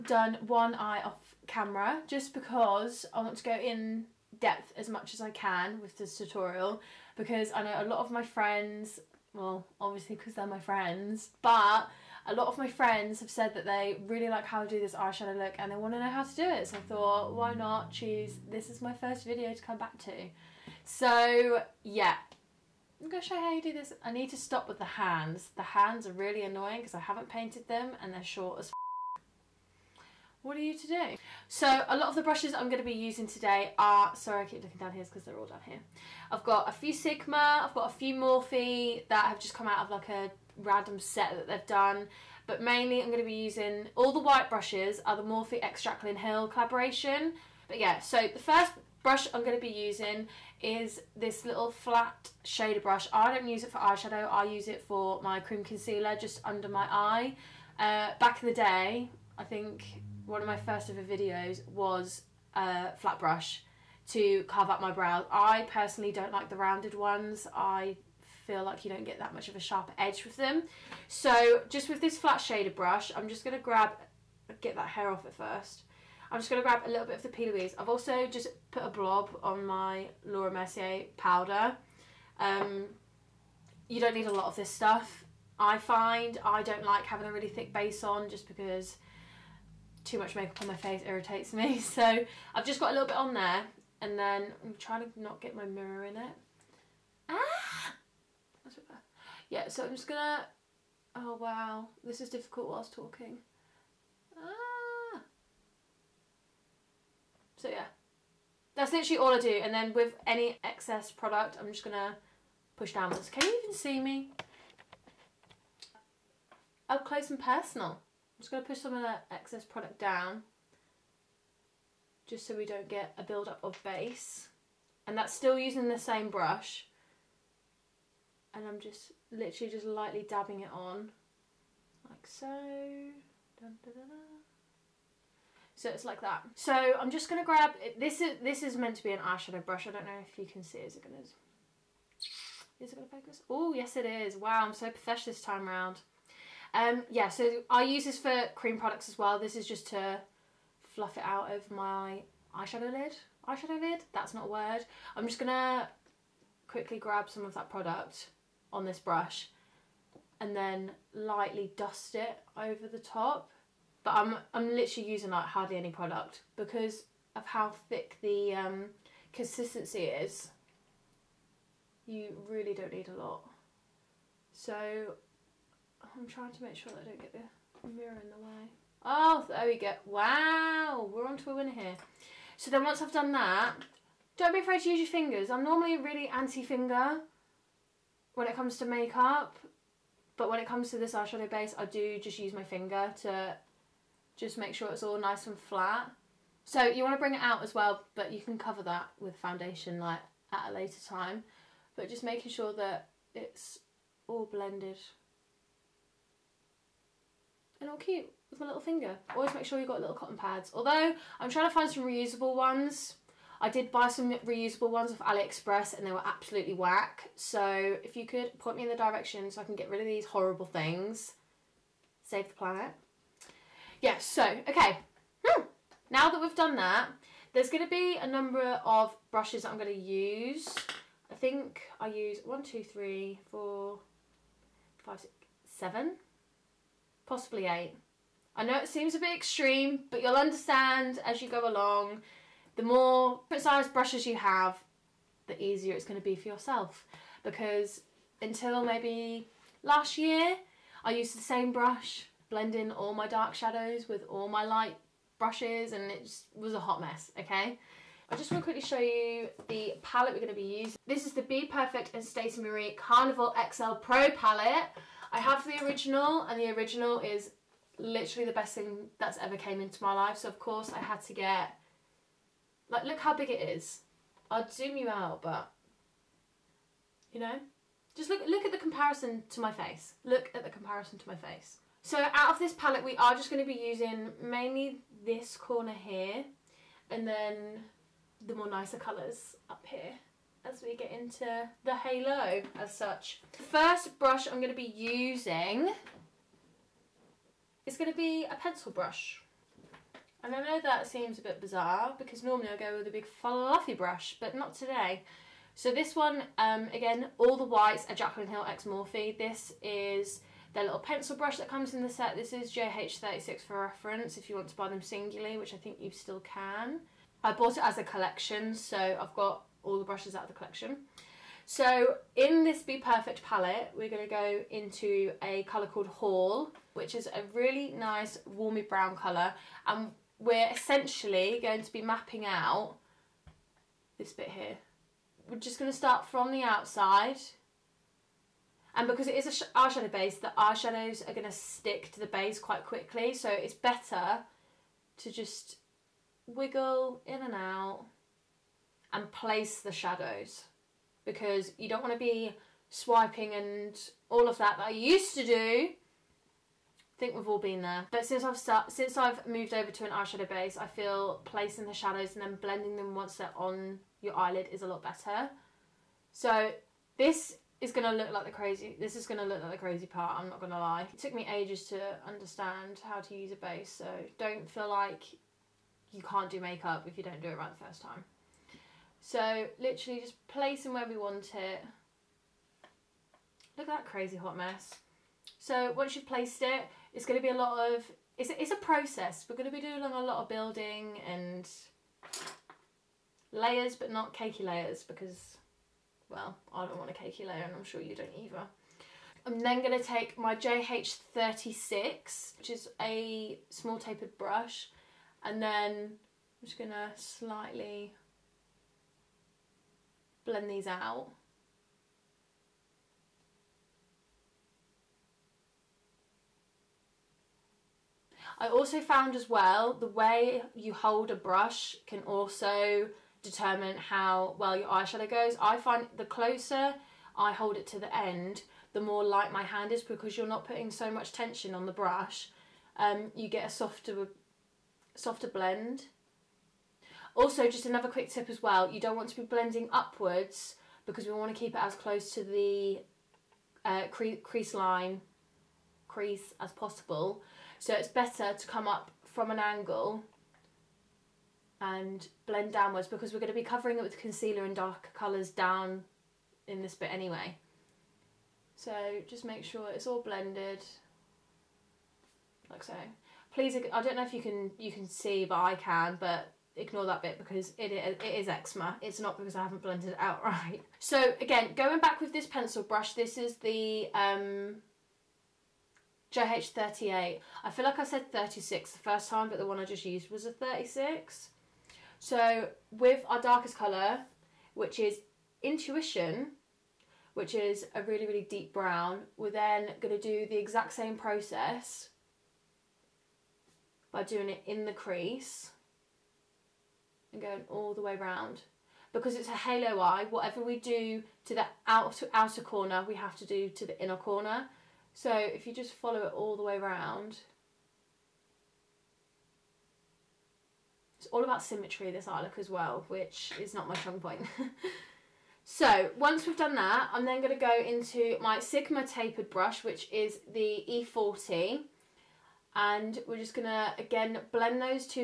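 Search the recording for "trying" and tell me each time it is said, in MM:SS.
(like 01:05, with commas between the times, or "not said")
01:34, 02:56, 03:31.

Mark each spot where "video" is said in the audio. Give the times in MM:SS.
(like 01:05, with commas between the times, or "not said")
00:19, 01:01.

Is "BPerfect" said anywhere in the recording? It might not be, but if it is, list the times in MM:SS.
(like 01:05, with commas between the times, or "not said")
04:21, 05:22.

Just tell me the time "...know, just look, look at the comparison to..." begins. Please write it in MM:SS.
04:37.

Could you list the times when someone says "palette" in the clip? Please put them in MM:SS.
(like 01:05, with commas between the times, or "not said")
04:20, 04:24, 04:42, 05:23.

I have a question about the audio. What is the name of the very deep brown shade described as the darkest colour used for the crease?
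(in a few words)
Intuition.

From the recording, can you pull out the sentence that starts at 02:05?
And that's still using the same brush.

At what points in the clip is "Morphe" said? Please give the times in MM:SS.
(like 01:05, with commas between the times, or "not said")
00:38, 00:45, 05:08.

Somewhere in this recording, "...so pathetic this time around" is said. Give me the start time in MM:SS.
02:24.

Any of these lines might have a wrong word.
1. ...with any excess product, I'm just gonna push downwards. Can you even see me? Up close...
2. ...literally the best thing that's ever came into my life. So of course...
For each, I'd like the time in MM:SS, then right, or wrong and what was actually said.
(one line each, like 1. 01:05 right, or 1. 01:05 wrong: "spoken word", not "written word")
1. 01:49 right
2. 04:27 right.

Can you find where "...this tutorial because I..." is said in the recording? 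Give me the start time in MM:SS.
00:05.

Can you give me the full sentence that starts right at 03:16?
So you want to bring it out as well, but you can cover that with foundation like at a later time.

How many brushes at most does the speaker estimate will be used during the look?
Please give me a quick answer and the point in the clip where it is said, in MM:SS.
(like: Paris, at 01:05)
8, at 03:57.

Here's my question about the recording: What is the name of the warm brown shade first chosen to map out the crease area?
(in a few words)
Hall.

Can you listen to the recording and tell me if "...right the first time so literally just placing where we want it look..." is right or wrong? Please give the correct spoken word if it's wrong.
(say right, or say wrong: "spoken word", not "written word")
right.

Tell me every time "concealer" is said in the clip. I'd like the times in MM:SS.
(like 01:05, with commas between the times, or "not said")
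00:55, 07:34.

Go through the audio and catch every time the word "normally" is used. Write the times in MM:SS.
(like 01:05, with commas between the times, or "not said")
03:05, 05:02.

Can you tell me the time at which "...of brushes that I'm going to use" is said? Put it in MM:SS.
03:48.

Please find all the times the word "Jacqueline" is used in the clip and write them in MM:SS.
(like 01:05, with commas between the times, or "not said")
00:45, 05:08.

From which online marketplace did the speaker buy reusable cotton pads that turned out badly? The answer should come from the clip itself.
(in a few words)
AliExpress.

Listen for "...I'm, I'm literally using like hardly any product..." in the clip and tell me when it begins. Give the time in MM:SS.
02:44.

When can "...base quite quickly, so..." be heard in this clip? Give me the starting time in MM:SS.
05:42.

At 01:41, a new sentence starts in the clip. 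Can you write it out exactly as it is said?
Oh wow, this is difficult whilst talking.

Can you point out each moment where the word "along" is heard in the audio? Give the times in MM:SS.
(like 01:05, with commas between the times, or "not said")
04:01.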